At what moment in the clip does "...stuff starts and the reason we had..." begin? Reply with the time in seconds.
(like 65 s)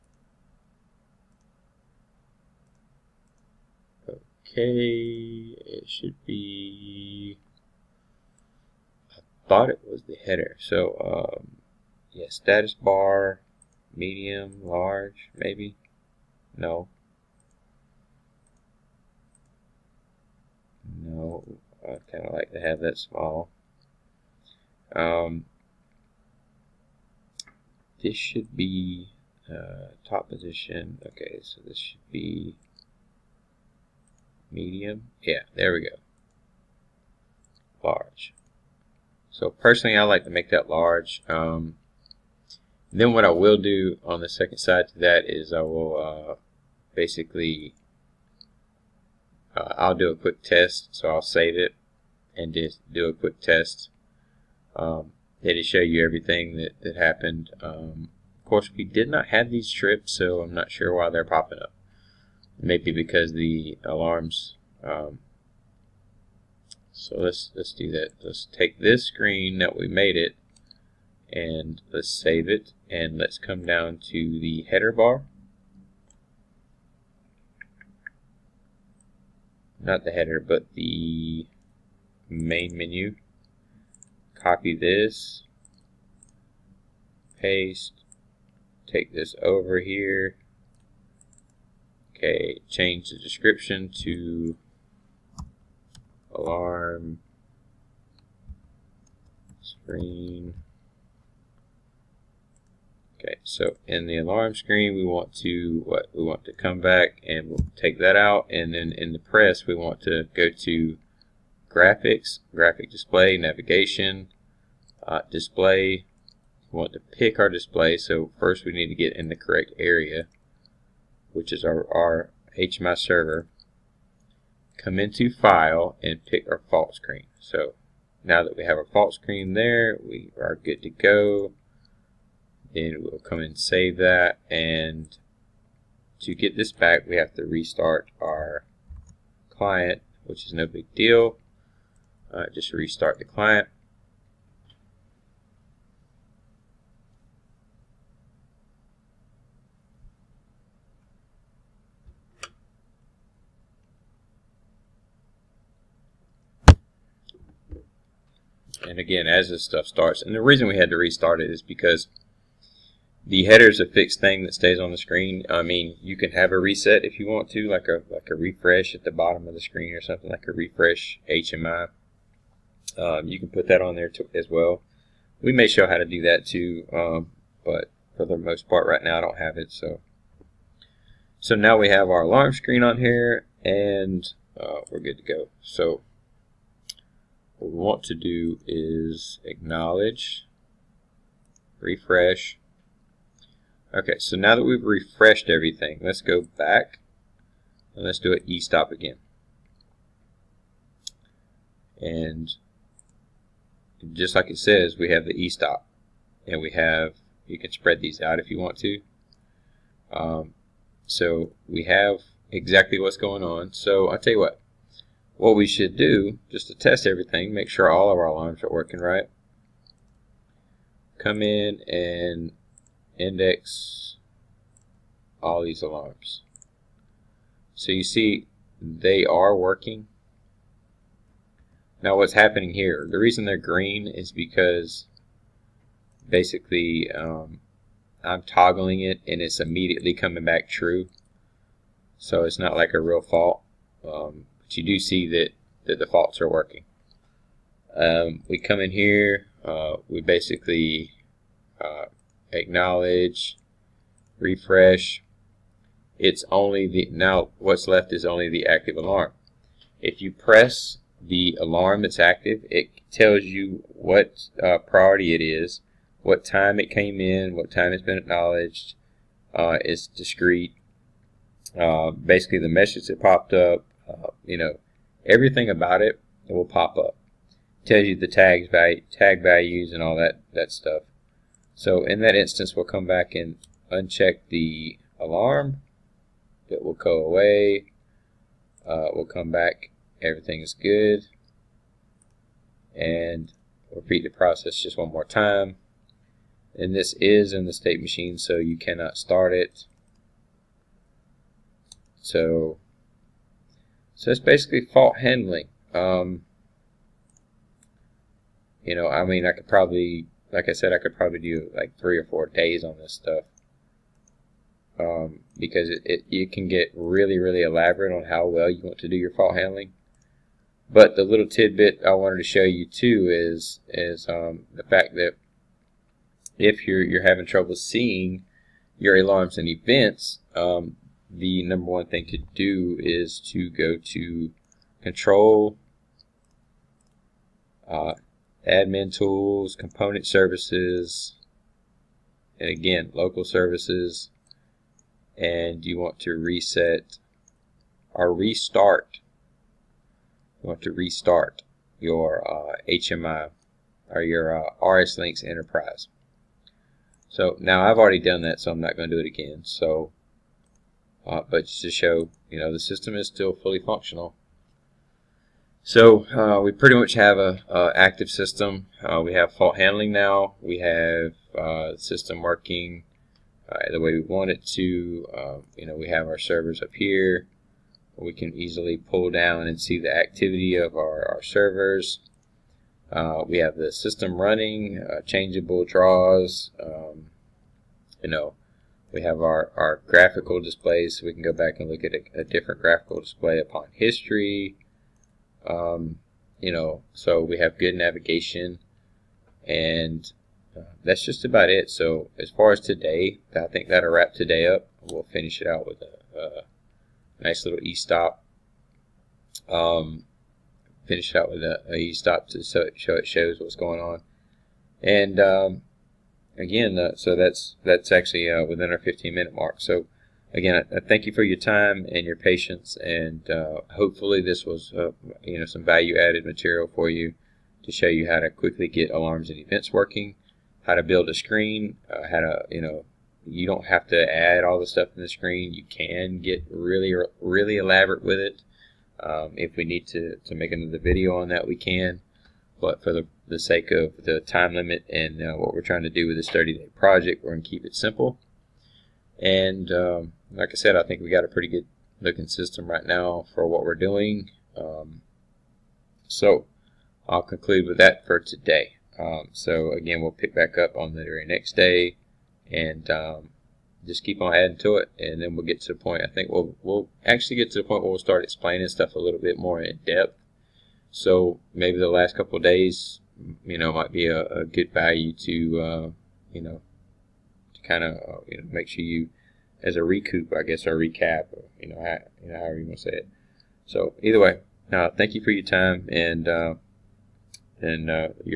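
159 s.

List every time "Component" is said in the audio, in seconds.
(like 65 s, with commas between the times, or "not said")
339 s.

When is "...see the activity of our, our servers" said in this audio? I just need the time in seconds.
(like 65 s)
379 s.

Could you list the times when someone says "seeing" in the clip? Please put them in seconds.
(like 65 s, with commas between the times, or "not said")
327 s.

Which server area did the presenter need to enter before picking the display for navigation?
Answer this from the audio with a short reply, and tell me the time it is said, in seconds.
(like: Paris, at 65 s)
HMI server, at 122 s.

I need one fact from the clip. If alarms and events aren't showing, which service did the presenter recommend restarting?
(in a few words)
RSLinx Enterprise.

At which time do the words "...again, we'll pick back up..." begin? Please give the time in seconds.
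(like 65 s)
459 s.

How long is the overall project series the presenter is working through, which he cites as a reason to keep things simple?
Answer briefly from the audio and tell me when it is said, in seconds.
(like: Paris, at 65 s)
30 days, at 446 s.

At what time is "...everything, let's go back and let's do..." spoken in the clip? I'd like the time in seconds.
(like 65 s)
195 s.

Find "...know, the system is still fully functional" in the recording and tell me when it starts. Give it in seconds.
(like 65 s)
362 s.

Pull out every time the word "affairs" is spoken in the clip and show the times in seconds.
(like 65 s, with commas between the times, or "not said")
not said.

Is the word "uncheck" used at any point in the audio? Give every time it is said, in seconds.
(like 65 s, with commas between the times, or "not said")
283 s.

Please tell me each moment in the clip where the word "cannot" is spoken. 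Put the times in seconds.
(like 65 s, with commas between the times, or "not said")
298 s.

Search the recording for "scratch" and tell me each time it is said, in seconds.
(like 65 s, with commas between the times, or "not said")
not said.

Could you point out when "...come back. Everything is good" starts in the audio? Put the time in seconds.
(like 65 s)
289 s.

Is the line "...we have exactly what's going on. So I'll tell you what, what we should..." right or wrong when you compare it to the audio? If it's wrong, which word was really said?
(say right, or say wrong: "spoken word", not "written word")
right.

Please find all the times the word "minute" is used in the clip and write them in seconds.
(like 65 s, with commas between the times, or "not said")
419 s.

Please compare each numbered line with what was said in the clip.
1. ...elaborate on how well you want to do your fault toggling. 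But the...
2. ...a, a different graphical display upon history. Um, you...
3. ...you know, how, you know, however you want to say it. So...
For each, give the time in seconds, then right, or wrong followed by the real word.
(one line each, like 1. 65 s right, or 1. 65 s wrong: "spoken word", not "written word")
1. 317 s wrong: "handling", not "toggling"
2. 392 s right
3. 481 s right.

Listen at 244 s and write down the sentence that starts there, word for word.
Um, but you do see that, that the faults are working.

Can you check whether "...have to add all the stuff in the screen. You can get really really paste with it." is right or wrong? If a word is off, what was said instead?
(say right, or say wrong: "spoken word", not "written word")
wrong: "elaborate", not "paste".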